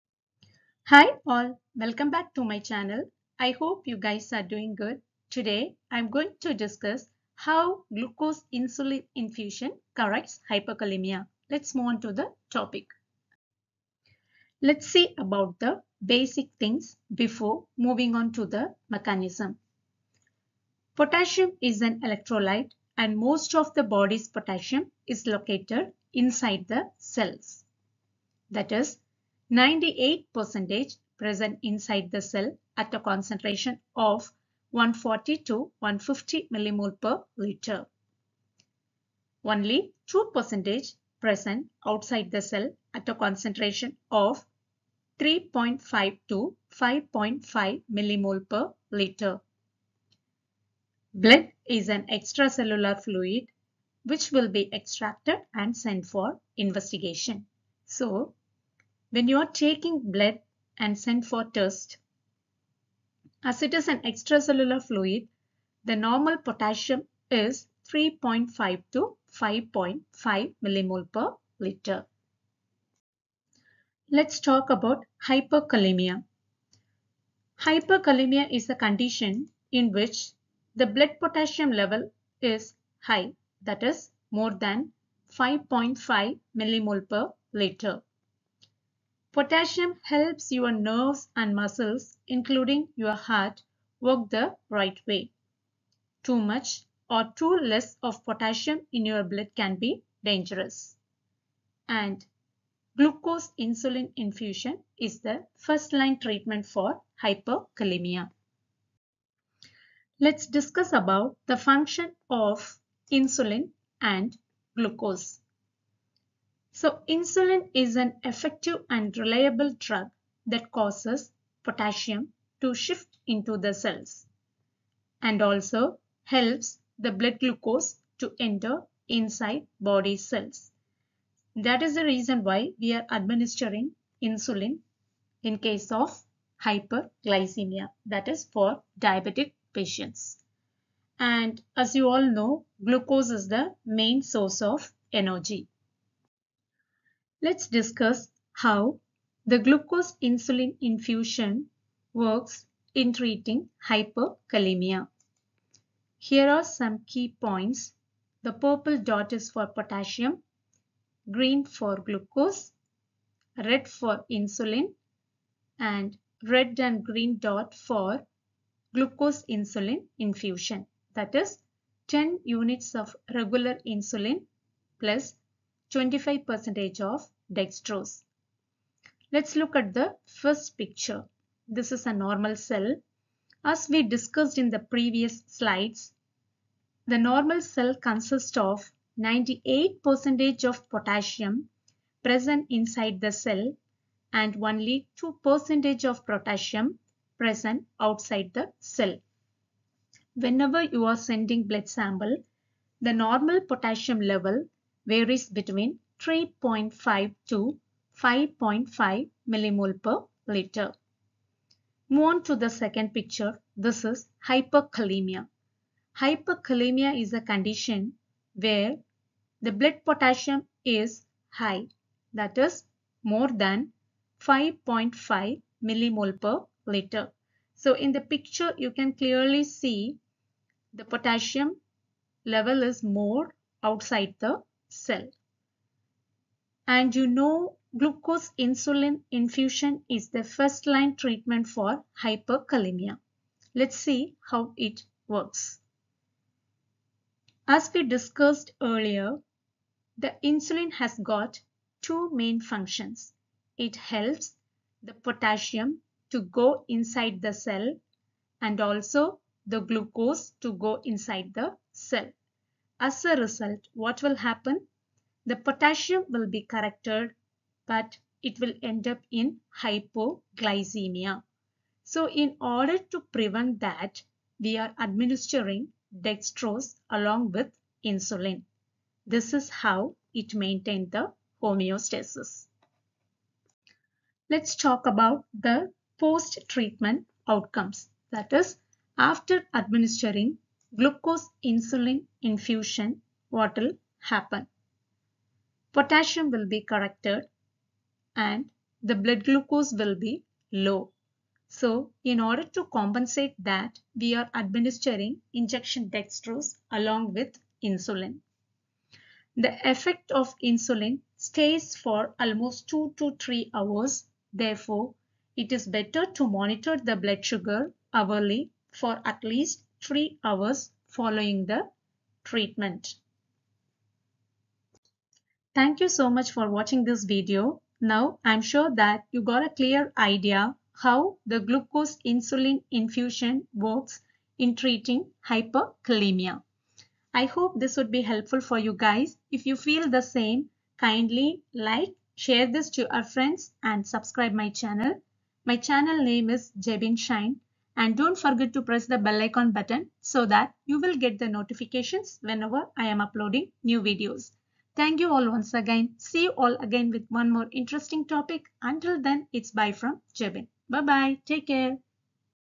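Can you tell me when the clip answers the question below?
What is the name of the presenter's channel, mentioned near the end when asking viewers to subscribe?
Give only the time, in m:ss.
5:46.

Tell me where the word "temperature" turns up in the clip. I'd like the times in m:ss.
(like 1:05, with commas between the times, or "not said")
not said.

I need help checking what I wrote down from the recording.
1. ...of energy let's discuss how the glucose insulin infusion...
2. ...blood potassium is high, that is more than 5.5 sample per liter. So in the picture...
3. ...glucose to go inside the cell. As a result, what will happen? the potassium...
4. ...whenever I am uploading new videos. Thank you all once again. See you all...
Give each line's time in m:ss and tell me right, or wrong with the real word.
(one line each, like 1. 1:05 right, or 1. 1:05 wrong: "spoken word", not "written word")
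1. 2:24 right
2. 3:39 wrong: "millimole", not "sample"
3. 4:19 right
4. 5:52 right.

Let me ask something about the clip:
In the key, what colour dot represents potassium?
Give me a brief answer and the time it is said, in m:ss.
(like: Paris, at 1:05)
purple, at 2:38.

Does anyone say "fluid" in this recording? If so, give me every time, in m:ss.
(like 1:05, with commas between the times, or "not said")
0:53, 1:04.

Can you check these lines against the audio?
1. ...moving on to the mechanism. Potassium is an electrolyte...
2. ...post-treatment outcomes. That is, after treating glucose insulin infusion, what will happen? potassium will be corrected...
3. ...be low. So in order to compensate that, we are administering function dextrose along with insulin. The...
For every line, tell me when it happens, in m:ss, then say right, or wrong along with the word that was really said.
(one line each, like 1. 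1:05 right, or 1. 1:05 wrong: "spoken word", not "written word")
1. 0:17 right
2. 4:46 wrong: "administering", not "treating"
3. 5:00 wrong: "injection", not "function".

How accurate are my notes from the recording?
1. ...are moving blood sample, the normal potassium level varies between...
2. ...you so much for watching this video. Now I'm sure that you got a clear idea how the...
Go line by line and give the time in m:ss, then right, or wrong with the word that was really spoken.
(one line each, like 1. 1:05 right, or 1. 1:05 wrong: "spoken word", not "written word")
1. 3:21 wrong: "sending", not "moving"
2. 5:26 right.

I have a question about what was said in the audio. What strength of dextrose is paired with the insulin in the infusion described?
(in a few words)
25%.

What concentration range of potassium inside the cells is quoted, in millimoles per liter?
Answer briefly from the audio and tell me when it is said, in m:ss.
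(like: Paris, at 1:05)
140 to 150, at 0:34.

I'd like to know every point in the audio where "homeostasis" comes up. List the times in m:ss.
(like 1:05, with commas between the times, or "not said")
4:41.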